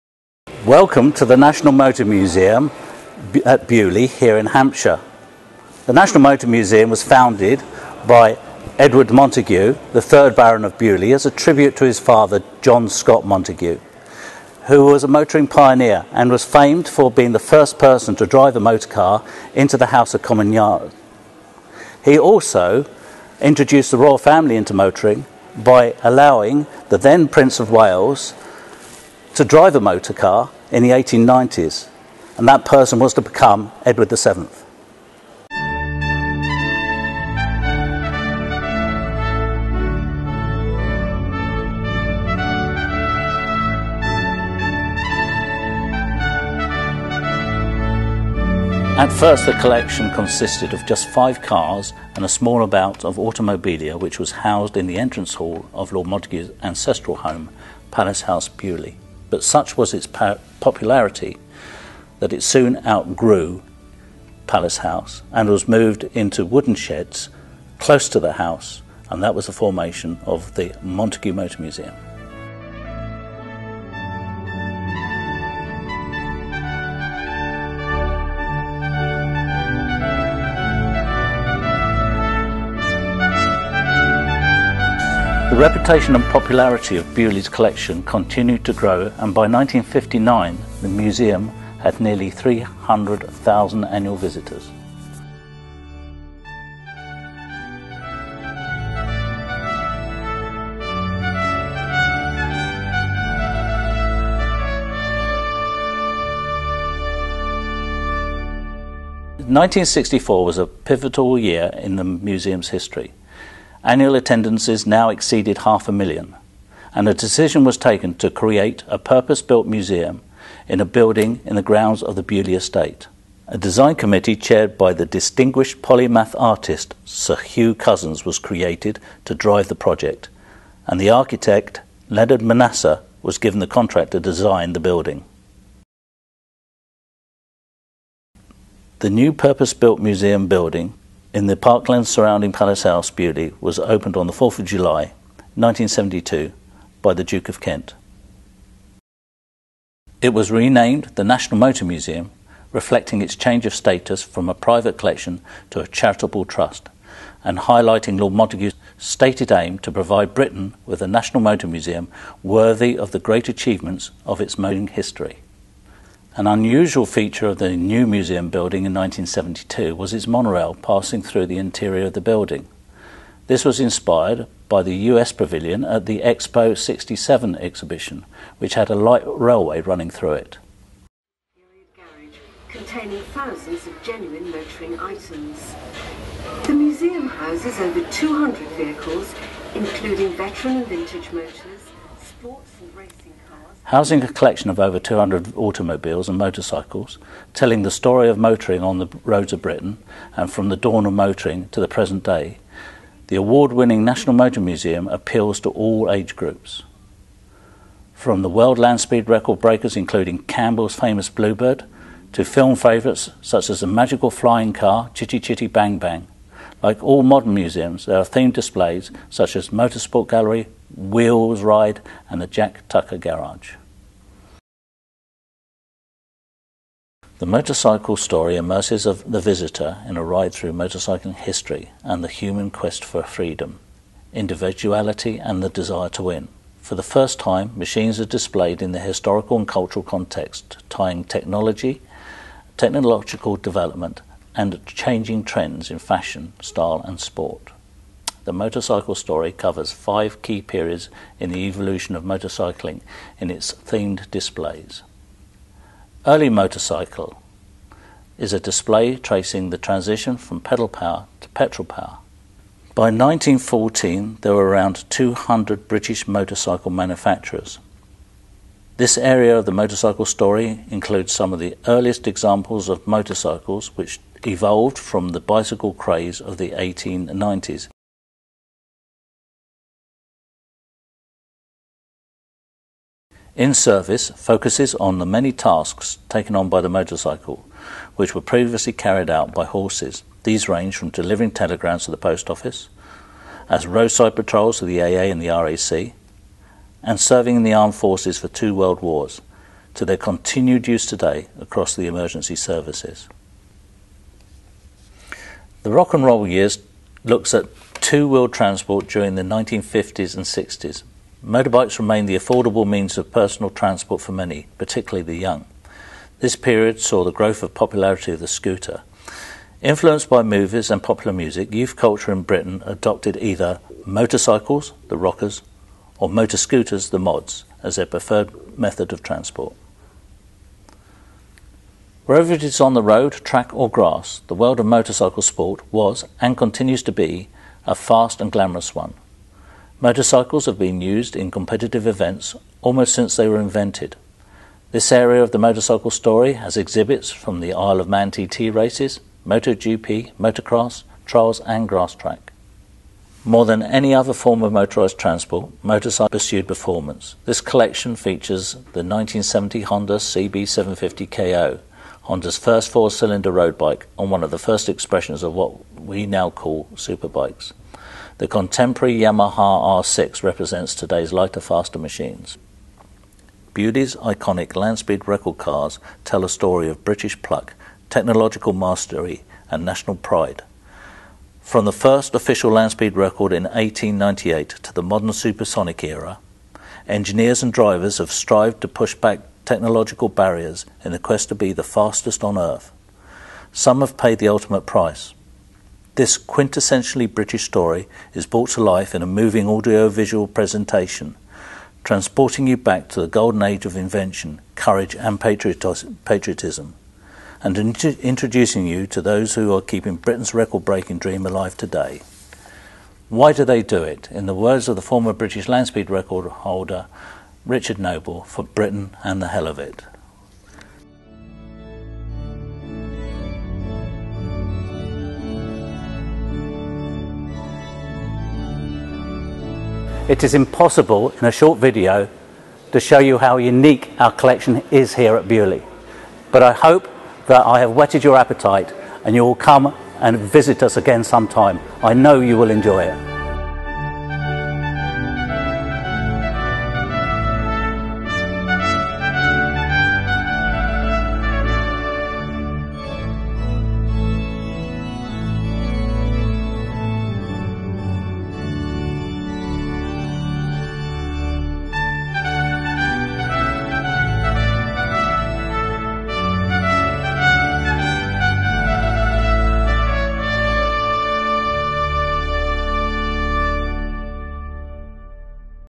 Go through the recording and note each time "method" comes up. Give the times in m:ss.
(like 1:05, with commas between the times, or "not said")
5:28.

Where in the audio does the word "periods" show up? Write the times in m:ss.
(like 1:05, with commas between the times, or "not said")
4:10, 5:16.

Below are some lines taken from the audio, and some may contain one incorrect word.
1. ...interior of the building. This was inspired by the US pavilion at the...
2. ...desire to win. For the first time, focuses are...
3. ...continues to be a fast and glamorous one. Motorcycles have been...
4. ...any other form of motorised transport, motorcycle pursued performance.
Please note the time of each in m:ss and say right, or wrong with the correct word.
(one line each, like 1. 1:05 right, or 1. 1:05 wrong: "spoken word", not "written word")
1. 2:51 right
2. 3:55 wrong: "machines", not "focuses"
3. 5:36 right
4. 5:53 right.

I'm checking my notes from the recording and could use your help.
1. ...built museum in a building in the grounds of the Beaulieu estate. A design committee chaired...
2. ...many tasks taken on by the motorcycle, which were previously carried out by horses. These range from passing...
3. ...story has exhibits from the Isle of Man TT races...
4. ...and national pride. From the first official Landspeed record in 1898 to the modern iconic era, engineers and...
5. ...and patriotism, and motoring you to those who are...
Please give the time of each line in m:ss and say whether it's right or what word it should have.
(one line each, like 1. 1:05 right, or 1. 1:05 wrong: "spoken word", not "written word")
1. 1:59 right
2. 4:45 wrong: "delivering", not "passing"
3. 5:46 right
4. 6:19 wrong: "supersonic", not "iconic"
5. 6:45 wrong: "introducing", not "motoring".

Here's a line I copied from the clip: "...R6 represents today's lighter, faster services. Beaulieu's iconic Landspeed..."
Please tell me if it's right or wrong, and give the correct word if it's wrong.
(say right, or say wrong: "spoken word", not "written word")
wrong: "machines", not "services".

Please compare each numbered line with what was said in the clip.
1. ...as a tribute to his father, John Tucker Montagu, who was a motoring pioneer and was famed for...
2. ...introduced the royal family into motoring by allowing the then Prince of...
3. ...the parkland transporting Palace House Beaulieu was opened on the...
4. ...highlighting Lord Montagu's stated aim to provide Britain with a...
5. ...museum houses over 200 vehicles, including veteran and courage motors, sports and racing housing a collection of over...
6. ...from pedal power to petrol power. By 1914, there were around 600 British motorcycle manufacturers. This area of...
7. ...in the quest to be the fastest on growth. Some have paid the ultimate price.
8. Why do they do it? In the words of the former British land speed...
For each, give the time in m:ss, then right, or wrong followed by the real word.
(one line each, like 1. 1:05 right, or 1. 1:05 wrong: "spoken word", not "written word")
1. 0:11 wrong: "Scott", not "Tucker"
2. 0:23 right
3. 2:21 wrong: "surrounding", not "transporting"
4. 2:37 right
5. 3:06 wrong: "vintage", not "courage"
6. 4:20 wrong: "200", not "600"
7. 6:31 wrong: "earth", not "growth"
8. 6:53 right.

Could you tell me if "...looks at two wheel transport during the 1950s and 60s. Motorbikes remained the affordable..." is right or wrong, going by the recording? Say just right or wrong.
right.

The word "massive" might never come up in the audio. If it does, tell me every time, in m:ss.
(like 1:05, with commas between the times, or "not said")
not said.